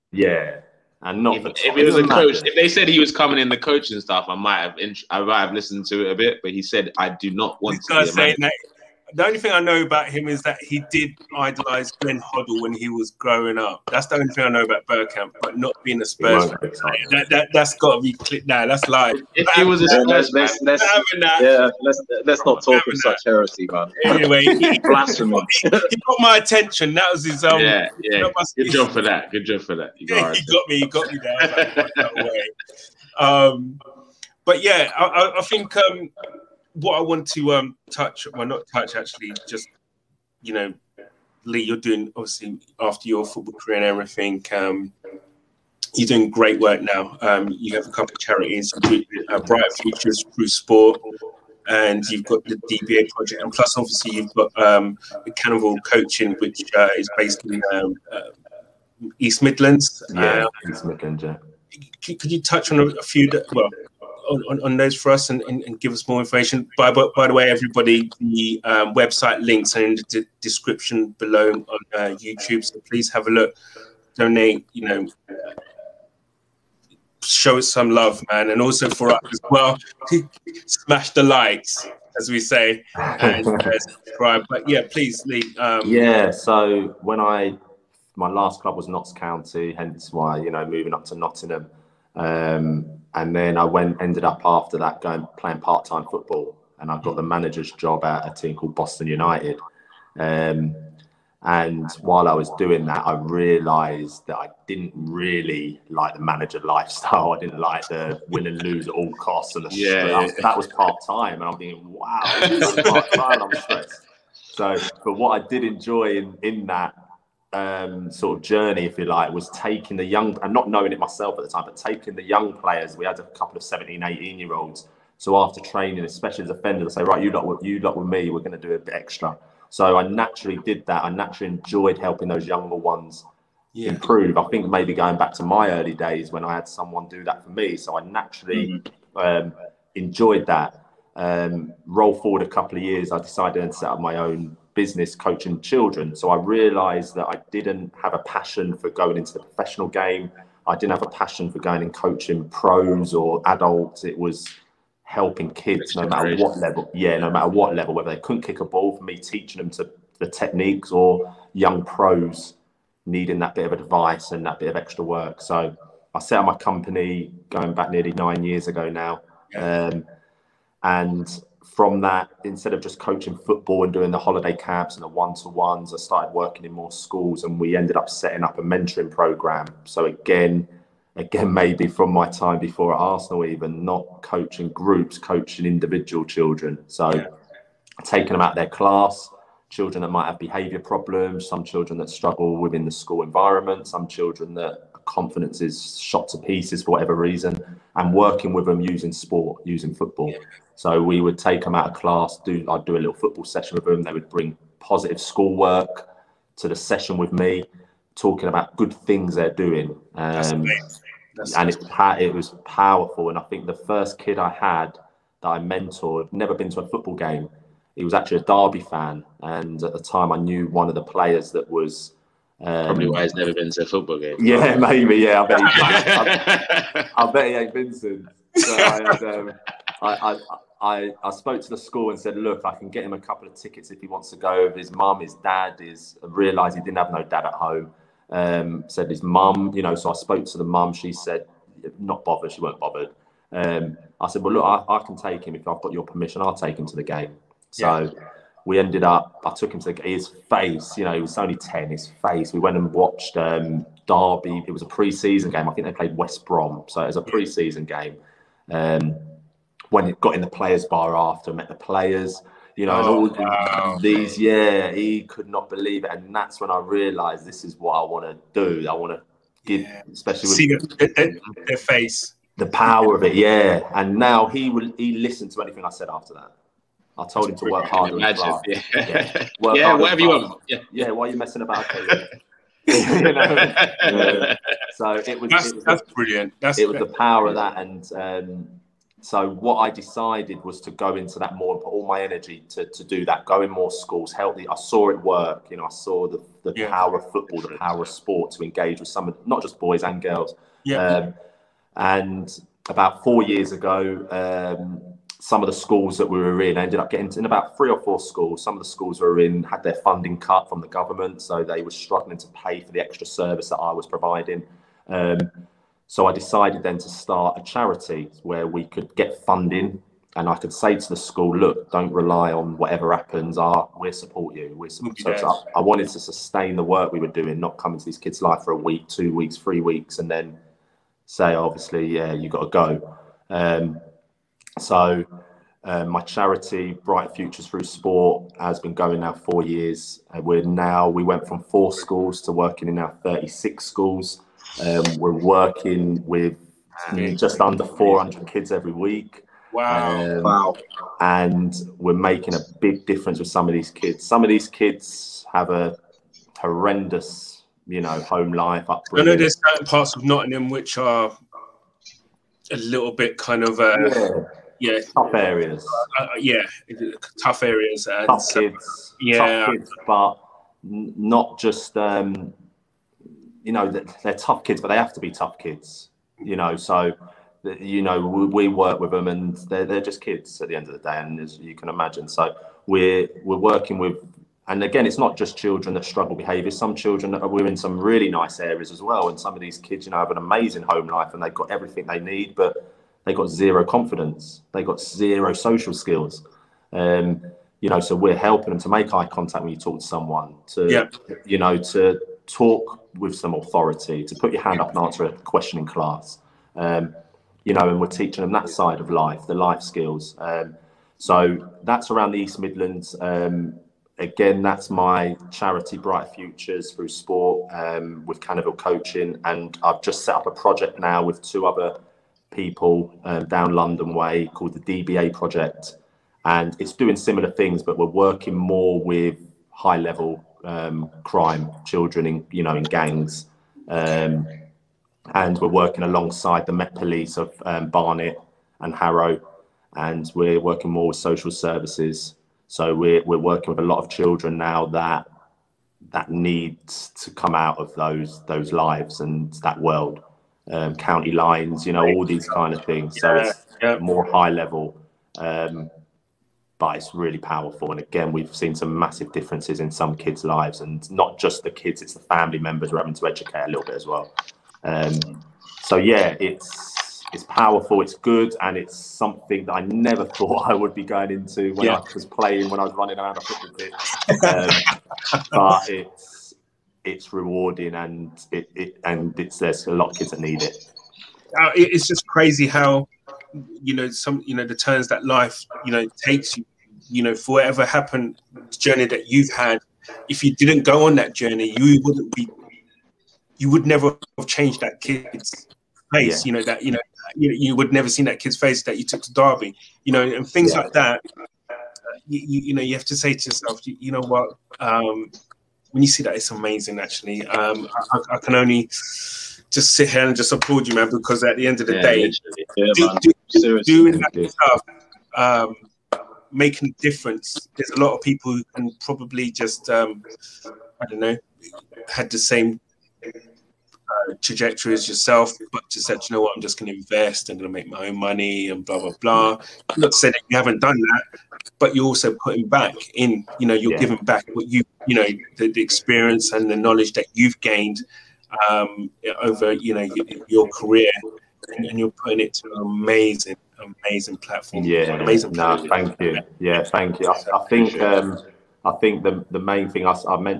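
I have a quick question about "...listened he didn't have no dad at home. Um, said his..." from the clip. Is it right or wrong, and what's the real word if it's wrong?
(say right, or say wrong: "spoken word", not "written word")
wrong: "realised", not "listened".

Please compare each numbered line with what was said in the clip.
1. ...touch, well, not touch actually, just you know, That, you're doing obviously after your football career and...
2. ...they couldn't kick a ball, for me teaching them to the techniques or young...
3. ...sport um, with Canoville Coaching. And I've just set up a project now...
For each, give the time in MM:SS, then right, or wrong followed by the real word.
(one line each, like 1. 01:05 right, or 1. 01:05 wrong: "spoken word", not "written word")
1. 00:37 wrong: "Lee", not "That"
2. 02:38 right
3. 06:57 right.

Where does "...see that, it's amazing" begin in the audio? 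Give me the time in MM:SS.
08:26.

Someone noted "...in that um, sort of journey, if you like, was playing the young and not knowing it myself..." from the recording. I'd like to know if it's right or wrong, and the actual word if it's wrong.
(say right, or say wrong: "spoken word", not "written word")
wrong: "taking", not "playing".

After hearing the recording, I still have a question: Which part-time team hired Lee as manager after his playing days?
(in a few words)
Boston United.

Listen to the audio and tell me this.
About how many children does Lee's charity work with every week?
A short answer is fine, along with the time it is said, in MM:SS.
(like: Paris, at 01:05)
400, at 05:47.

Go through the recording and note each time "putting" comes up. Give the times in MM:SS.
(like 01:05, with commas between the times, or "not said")
08:52, 09:02.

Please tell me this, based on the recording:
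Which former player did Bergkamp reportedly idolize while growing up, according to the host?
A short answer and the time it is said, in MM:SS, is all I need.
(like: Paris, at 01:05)
Glenn Hoddle, at 00:11.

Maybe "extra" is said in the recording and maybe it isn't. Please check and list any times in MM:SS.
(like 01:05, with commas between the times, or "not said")
02:08, 02:44, 05:13.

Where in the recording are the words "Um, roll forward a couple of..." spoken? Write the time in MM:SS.
02:21.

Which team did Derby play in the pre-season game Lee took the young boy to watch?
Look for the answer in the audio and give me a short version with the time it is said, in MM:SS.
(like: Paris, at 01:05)
West Brom, at 04:16.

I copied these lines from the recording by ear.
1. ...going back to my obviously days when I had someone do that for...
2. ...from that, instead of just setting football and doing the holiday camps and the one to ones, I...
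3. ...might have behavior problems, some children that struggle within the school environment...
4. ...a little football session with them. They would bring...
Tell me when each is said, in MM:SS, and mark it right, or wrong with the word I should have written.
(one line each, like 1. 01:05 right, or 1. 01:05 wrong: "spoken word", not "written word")
1. 02:14 wrong: "early", not "obviously"
2. 02:51 wrong: "coaching", not "setting"
3. 03:10 right
4. 03:22 right.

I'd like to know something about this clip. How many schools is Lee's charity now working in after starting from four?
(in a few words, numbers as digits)
36.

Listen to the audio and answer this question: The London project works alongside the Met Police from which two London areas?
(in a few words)
Barnet and Harrow.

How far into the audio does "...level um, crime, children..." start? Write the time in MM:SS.
07:09.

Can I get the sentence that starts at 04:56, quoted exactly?
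power of football, the power of sport to engage with some of not just boys and girls.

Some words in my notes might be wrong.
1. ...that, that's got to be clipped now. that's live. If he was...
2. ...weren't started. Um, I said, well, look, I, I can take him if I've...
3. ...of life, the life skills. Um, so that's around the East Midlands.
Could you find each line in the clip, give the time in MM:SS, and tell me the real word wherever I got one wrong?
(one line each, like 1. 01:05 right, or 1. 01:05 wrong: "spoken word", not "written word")
1. 00:17 right
2. 04:02 wrong: "bothered", not "started"
3. 06:49 right.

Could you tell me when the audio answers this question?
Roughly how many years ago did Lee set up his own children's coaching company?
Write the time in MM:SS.
02:48.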